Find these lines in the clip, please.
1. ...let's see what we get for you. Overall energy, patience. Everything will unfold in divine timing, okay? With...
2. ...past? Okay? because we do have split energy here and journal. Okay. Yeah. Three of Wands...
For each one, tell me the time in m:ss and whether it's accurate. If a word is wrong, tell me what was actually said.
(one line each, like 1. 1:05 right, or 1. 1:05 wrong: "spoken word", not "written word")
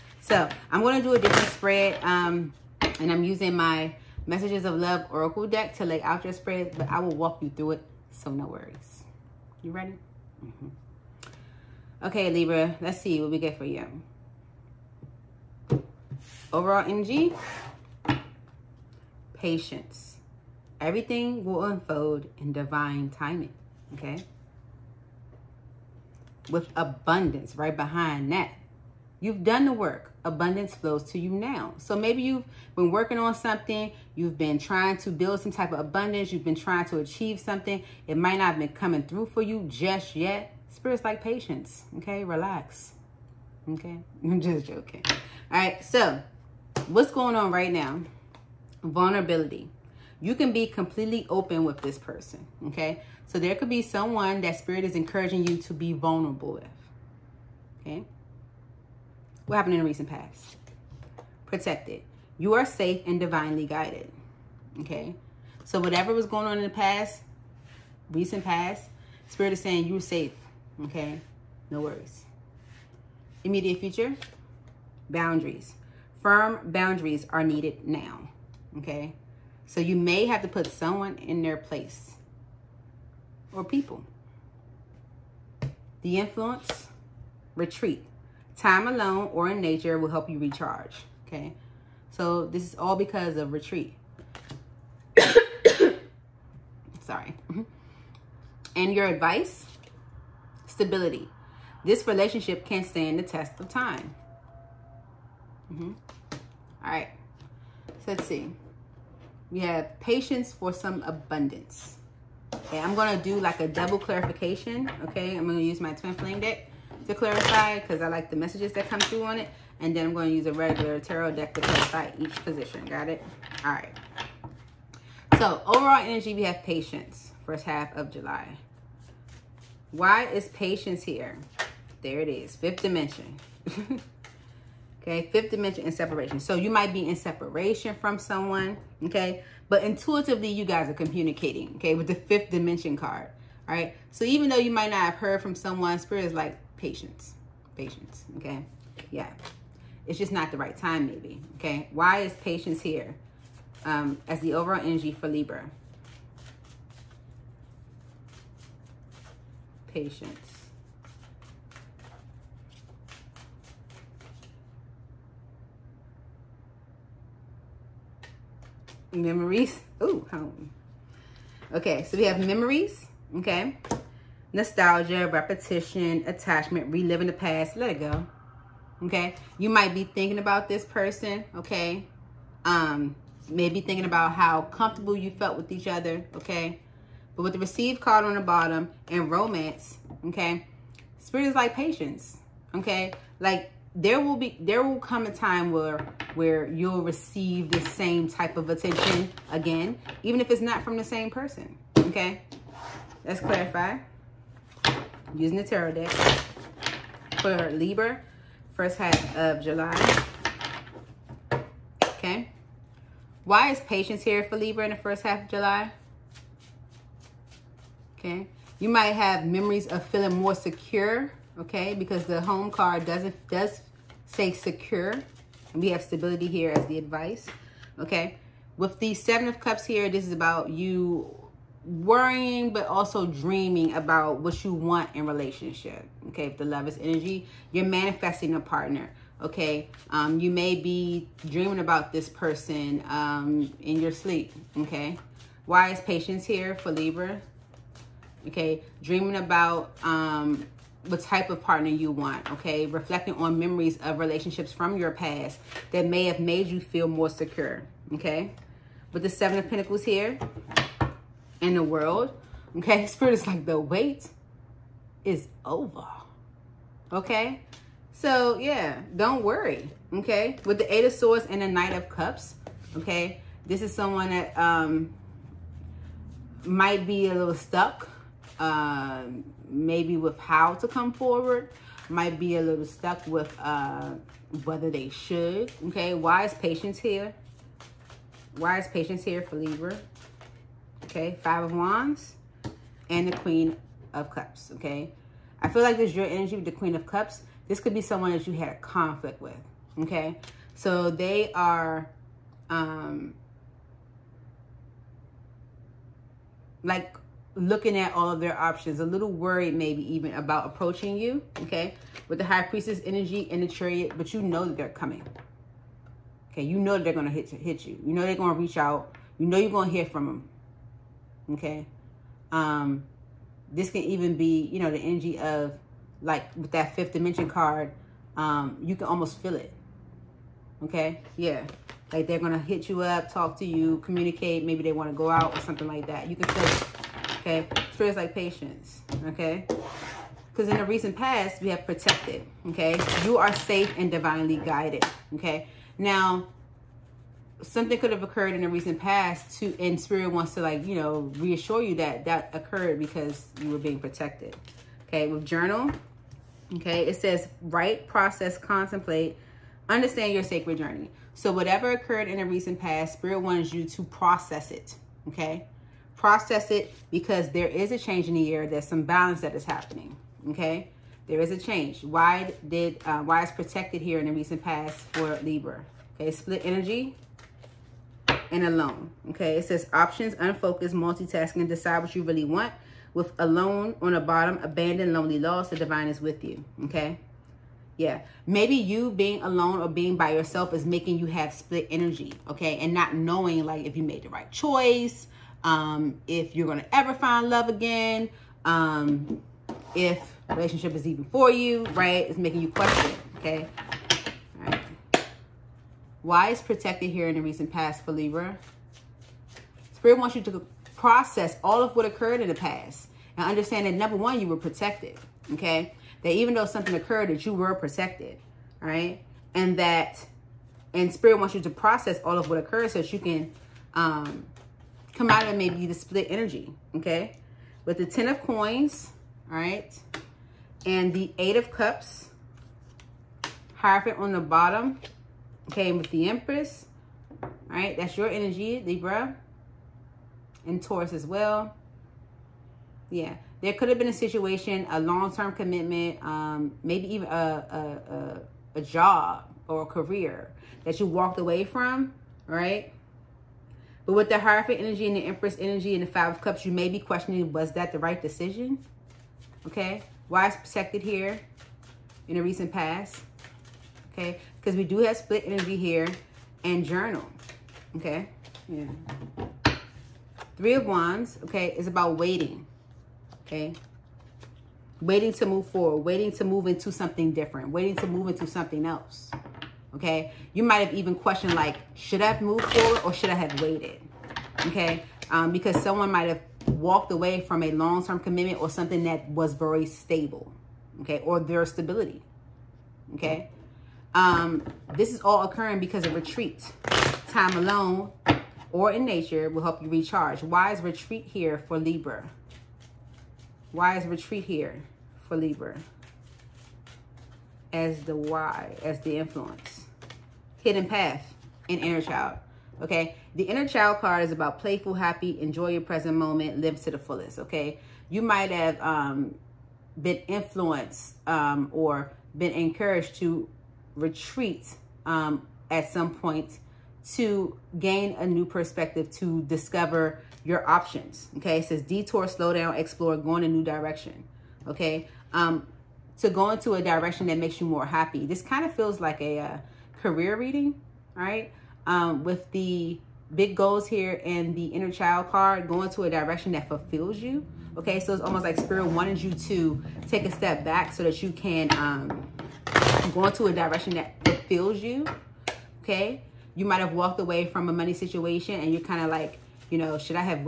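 1. 0:12 right
2. 7:42 right.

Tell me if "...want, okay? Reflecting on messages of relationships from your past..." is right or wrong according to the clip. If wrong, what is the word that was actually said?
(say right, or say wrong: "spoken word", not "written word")
wrong: "memories", not "messages".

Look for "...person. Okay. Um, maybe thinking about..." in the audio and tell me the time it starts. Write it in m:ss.
3:00.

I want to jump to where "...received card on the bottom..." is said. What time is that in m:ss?
3:07.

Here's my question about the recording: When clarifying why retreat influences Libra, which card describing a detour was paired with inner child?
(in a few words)
Hidden path.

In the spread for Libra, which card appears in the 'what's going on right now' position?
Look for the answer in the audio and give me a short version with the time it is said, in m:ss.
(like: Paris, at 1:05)
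Vulnerability, at 0:48.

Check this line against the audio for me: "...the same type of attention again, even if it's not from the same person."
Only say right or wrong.
right.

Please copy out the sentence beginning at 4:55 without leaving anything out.
I feel like there's your energy with the Queen of Cups.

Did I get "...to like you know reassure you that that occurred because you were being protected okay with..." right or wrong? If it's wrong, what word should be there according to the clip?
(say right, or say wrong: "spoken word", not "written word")
right.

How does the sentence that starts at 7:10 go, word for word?
And the Eight of Cups, Hierophant on the bottom, came with the Empress.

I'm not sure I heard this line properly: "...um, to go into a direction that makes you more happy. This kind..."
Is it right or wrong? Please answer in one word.
right.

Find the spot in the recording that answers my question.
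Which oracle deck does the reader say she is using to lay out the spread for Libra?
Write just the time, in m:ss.
0:04.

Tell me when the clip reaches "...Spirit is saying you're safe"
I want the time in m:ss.
1:09.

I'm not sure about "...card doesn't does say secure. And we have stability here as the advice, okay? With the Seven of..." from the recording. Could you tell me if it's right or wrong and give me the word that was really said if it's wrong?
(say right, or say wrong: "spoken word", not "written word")
right.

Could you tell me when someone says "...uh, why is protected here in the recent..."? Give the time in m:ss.
6:13.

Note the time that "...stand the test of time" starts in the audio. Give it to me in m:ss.
1:42.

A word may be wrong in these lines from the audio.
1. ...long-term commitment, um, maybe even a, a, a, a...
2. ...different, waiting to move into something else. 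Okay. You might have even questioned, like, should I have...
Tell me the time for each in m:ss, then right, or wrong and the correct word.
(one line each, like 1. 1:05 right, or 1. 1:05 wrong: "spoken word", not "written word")
1. 7:25 right
2. 7:57 right.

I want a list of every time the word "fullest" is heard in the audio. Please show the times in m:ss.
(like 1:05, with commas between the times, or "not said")
8:36.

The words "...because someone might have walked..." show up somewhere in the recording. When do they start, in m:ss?
8:05.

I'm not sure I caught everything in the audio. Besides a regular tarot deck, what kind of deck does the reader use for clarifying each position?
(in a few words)
twin flame deck.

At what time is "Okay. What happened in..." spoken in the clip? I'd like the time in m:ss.
0:57.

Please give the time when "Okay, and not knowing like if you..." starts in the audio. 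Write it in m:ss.
6:32.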